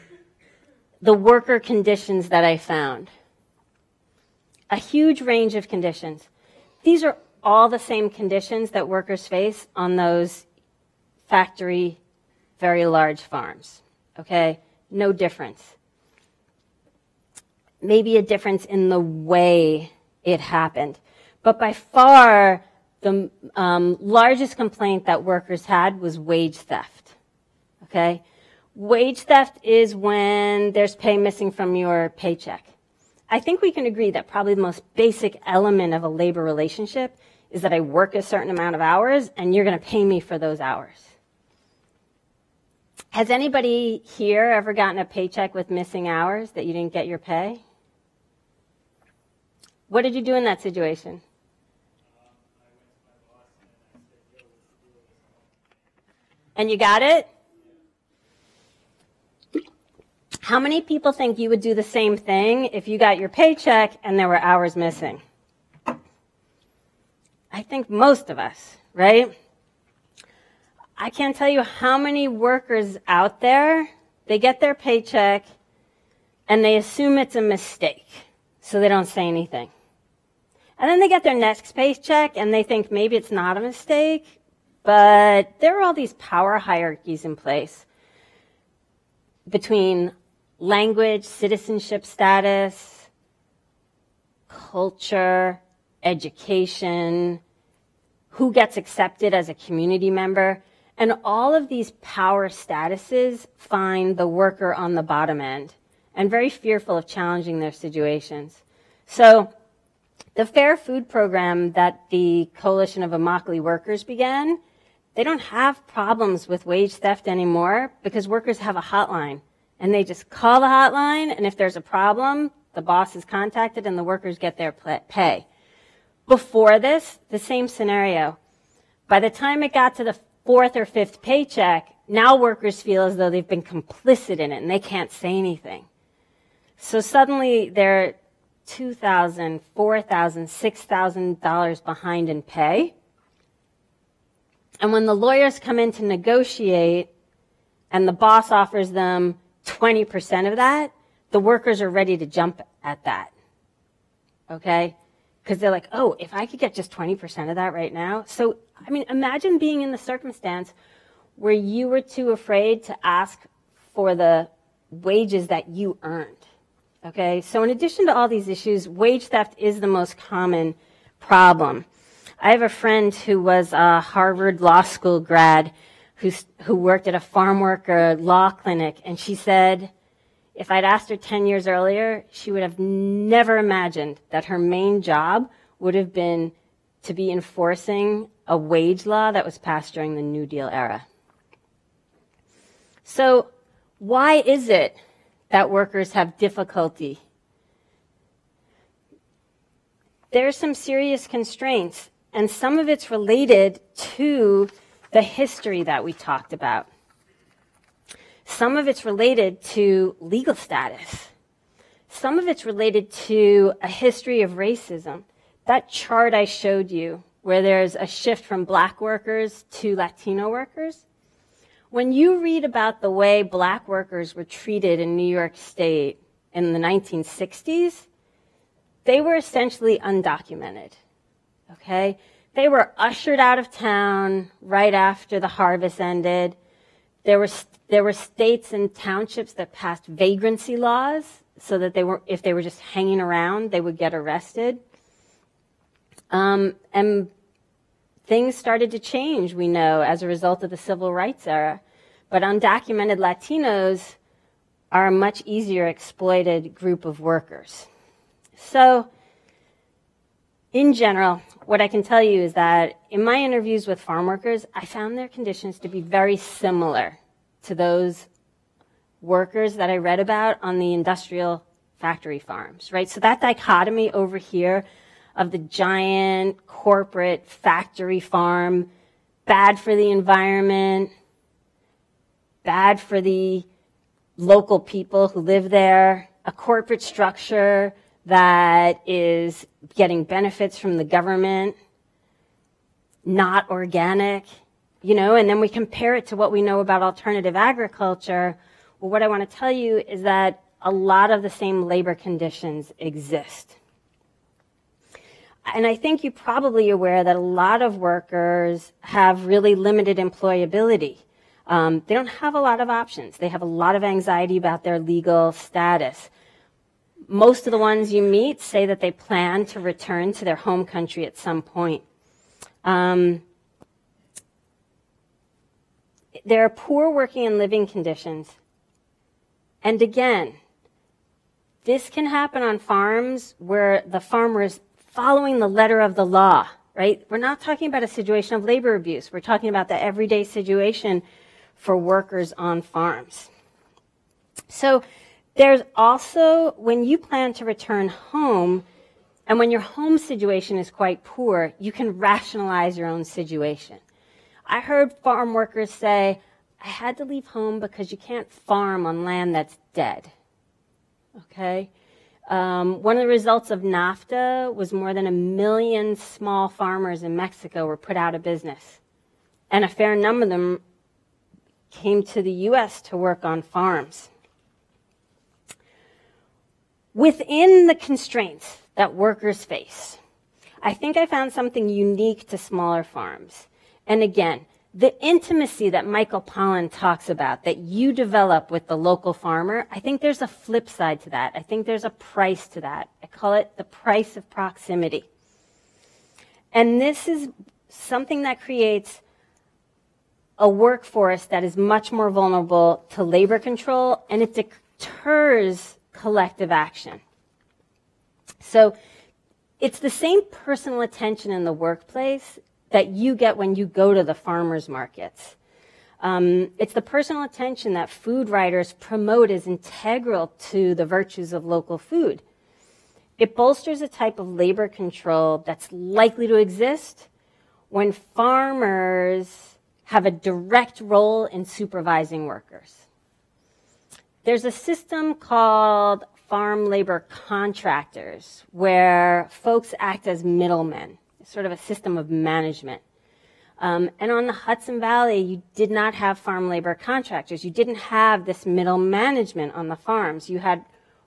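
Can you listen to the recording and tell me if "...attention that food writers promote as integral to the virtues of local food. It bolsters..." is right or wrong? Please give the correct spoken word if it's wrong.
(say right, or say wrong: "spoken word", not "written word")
right.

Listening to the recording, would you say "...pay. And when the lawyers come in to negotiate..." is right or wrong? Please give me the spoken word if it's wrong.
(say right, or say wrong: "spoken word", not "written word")
right.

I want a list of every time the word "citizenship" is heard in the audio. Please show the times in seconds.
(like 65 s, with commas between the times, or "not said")
91 s.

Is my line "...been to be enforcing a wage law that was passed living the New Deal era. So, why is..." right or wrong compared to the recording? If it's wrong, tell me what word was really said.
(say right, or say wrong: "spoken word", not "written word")
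wrong: "during", not "living".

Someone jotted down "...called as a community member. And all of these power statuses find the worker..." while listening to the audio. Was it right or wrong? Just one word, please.
wrong.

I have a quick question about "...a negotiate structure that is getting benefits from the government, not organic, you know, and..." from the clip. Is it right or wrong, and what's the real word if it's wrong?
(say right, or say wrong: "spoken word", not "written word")
wrong: "corporate", not "negotiate".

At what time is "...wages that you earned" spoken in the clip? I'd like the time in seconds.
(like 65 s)
164 s.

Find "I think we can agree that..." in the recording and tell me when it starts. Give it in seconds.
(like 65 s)
33 s.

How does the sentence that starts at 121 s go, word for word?
And if there's a problem, the boss is contacted and the workers get their pay.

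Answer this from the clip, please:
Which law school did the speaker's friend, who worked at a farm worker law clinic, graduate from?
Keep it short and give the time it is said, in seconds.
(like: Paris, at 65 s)
Harvard Law School, at 173 s.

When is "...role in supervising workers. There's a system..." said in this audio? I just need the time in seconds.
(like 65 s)
431 s.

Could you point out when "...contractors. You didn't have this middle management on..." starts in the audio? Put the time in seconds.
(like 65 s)
446 s.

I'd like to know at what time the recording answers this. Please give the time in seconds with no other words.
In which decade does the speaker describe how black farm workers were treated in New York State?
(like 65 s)
226 s.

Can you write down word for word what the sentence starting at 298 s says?
Well, what I want to tell you is that a lot of the same labor conditions exist.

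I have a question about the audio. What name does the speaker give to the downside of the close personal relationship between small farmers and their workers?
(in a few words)
The price of proximity.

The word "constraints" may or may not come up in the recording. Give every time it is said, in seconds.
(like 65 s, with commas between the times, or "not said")
201 s, 377 s.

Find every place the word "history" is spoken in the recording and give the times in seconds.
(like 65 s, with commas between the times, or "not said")
205 s, 213 s.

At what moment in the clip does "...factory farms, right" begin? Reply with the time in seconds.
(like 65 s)
271 s.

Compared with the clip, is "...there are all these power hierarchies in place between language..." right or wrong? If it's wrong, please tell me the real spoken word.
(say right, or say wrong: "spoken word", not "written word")
right.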